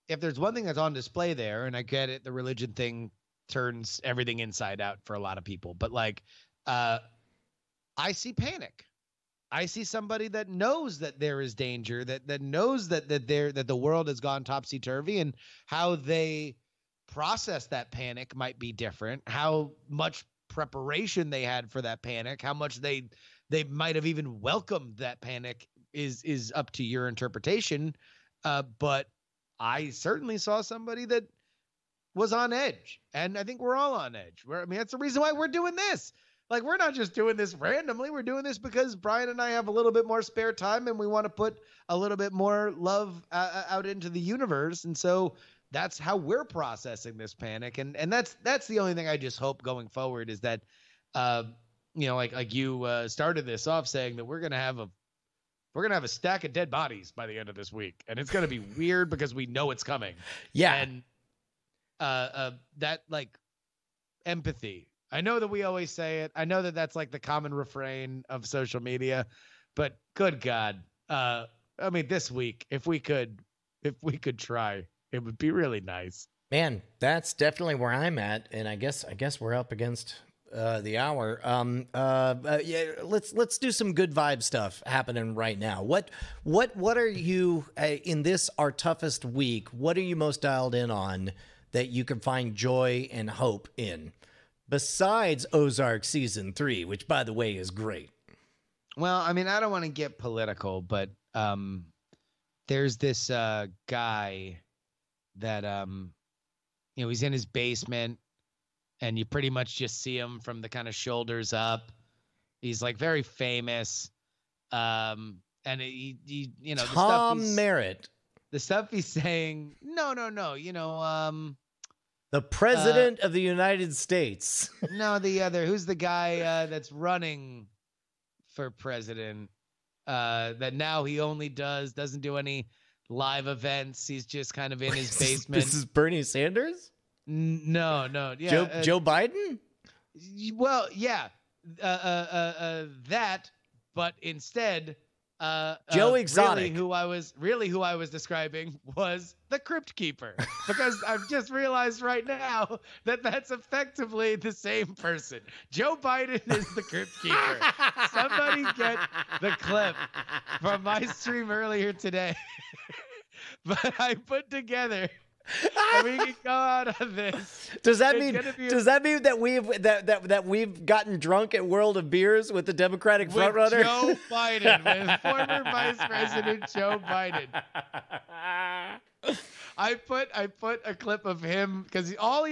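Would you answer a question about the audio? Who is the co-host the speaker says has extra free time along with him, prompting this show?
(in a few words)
Brian.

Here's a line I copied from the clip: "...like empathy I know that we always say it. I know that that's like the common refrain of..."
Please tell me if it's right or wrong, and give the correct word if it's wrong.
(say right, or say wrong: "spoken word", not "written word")
right.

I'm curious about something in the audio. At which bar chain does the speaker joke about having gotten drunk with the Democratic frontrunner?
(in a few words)
World of Beers.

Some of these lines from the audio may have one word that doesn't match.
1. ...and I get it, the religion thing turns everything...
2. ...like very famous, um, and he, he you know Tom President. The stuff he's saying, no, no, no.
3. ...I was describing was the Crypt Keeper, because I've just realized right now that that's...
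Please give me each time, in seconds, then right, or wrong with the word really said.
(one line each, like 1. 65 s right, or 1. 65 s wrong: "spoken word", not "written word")
1. 1 s right
2. 112 s wrong: "Merritt", not "President"
3. 147 s right.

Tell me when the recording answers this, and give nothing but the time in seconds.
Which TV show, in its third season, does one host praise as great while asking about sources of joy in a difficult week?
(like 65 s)
95 s.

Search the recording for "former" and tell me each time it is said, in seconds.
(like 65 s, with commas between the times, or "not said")
175 s.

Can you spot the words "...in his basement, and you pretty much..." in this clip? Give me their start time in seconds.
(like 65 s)
107 s.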